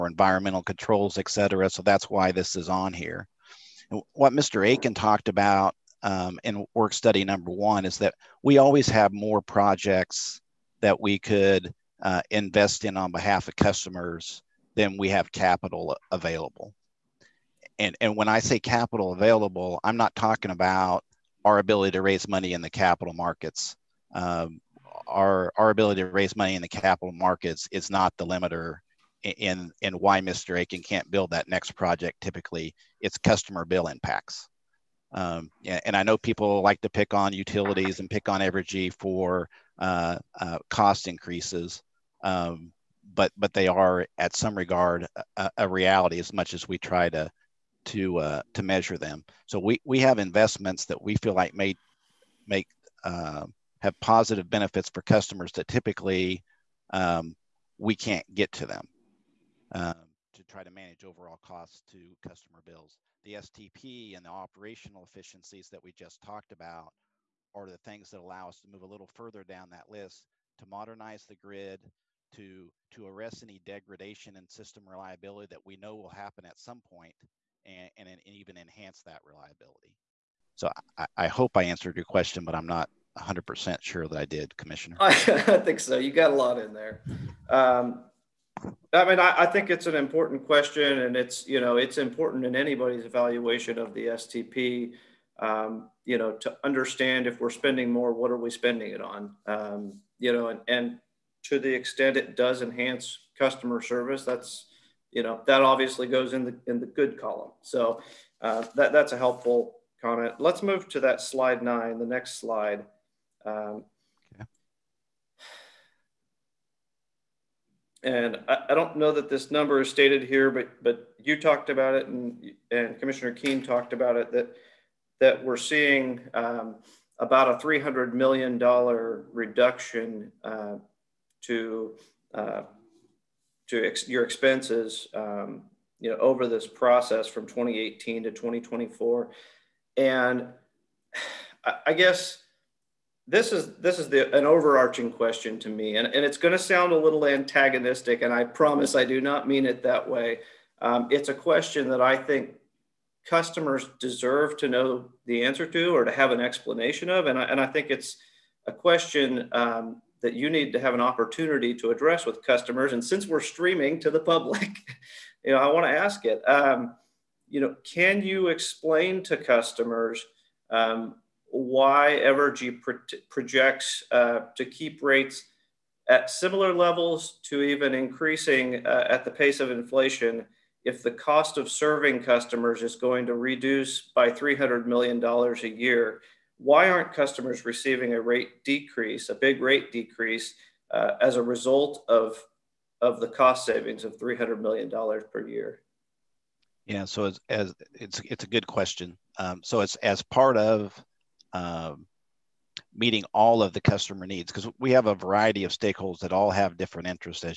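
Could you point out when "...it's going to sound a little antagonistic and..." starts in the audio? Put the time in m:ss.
2:26.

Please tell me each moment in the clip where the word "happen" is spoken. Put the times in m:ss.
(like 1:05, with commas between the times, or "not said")
1:16.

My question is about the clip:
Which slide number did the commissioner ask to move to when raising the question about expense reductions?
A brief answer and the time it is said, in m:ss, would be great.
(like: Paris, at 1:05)
9, at 1:51.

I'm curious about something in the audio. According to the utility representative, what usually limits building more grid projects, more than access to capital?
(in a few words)
Customer bill impacts.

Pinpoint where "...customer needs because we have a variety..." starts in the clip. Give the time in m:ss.
3:23.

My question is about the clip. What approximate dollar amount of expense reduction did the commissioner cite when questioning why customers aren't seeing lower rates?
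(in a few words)
$300 million.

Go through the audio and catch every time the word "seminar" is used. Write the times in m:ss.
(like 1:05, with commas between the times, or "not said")
not said.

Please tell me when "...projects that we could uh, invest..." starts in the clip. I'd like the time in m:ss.
0:09.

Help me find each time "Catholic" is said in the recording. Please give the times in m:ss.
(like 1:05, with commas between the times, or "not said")
not said.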